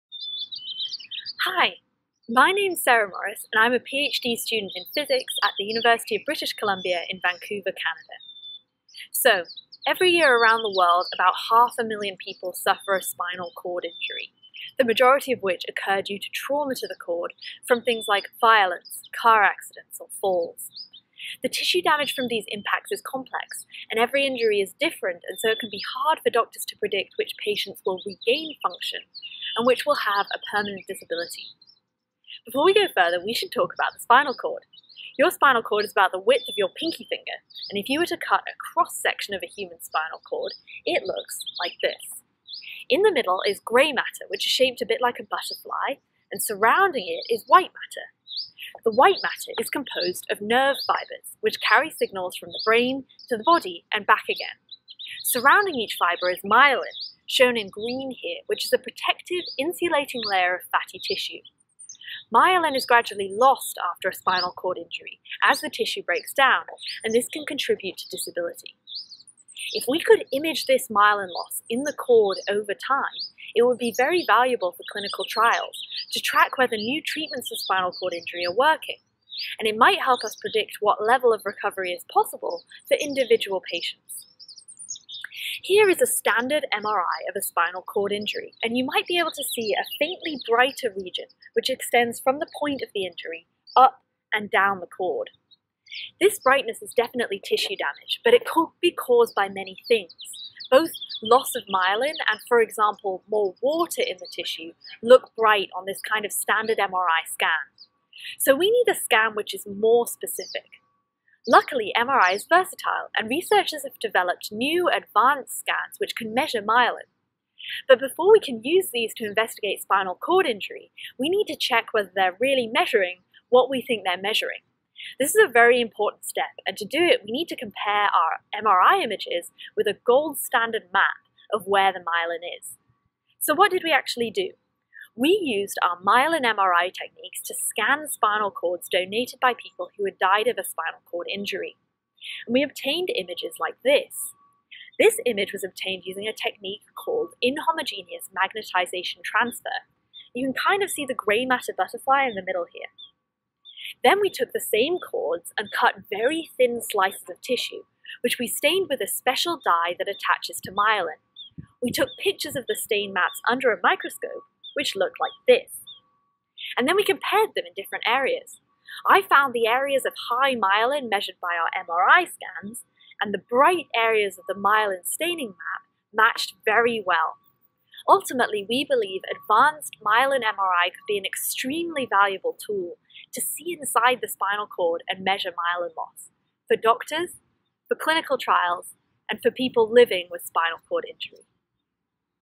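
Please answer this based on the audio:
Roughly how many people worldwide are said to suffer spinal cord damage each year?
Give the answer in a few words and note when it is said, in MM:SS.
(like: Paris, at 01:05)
half a million, at 00:11.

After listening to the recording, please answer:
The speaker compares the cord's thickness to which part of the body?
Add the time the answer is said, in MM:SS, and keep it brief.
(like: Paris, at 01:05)
pinky finger, at 00:36.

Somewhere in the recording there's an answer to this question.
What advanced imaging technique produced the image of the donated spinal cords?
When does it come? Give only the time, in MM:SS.
02:27.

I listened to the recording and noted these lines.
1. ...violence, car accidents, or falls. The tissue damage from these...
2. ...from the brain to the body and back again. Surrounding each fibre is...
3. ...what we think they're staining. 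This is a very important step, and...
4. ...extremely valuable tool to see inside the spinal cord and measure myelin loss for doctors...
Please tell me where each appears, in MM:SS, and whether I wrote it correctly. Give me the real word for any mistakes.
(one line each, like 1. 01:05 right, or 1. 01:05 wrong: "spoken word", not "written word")
1. 00:18 right
2. 00:52 right
3. 02:03 wrong: "measuring", not "staining"
4. 03:01 right.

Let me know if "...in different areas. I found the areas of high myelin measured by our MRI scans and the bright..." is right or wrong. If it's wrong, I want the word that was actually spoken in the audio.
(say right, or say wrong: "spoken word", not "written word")
right.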